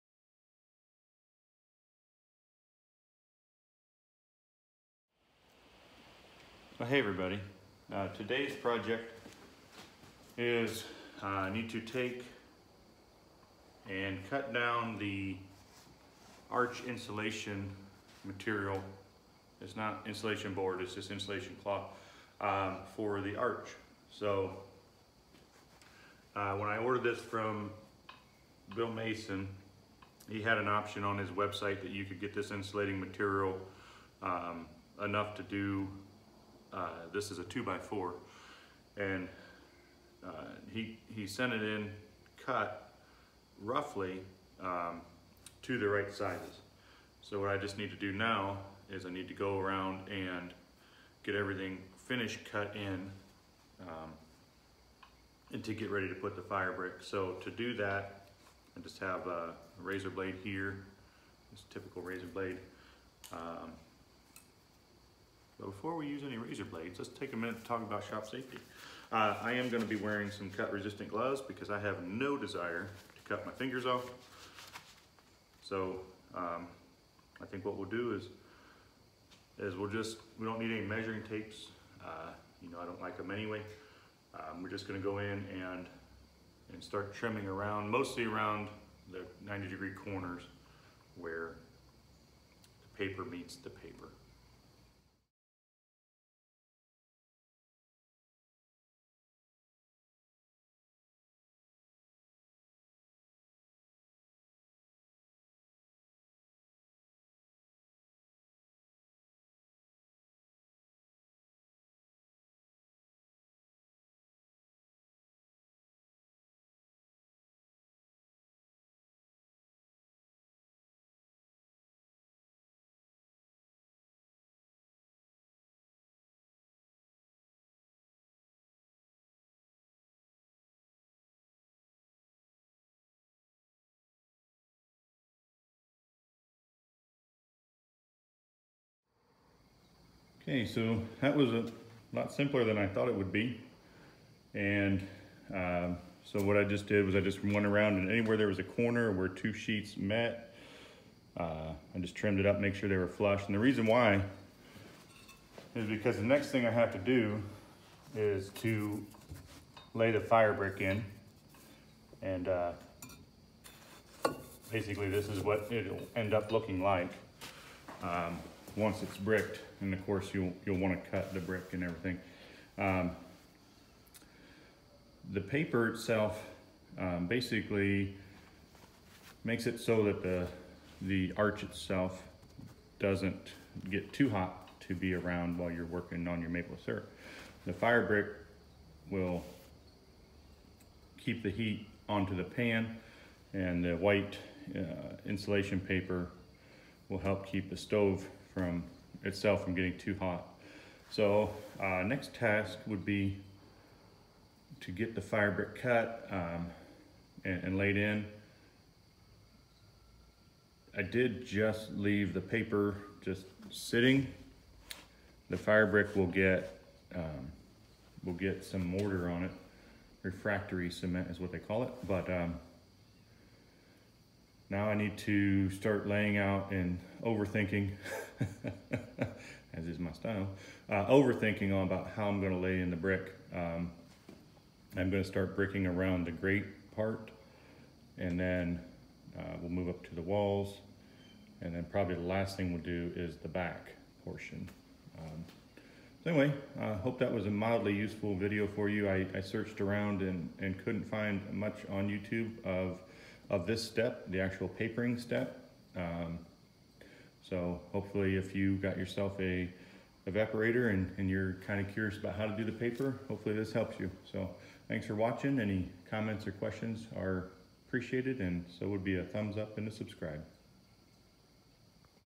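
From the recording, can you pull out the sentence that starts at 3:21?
So uh, next task would be to get the fire brick cut um, and, and laid in.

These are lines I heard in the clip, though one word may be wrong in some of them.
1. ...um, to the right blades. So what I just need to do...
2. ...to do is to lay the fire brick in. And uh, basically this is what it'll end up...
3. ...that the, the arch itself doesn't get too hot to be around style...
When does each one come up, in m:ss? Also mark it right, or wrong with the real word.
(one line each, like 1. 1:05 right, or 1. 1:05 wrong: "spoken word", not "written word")
1. 0:44 wrong: "sizes", not "blades"
2. 2:36 right
3. 3:00 wrong: "while", not "style".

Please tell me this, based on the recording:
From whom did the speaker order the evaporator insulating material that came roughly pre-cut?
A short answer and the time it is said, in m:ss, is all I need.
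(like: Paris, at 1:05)
Bill Mason, at 0:28.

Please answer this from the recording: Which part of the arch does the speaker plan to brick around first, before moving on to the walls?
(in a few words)
The grate.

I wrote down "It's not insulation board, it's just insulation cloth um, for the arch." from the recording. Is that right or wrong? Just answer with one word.
right.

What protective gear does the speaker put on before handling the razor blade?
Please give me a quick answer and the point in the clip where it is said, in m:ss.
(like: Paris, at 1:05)
Cut resistant gloves, at 1:10.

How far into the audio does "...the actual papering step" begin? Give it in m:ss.
4:14.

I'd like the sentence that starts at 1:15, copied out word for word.
So um, I think what we'll do is, is we'll just, we don't need any measuring tapes.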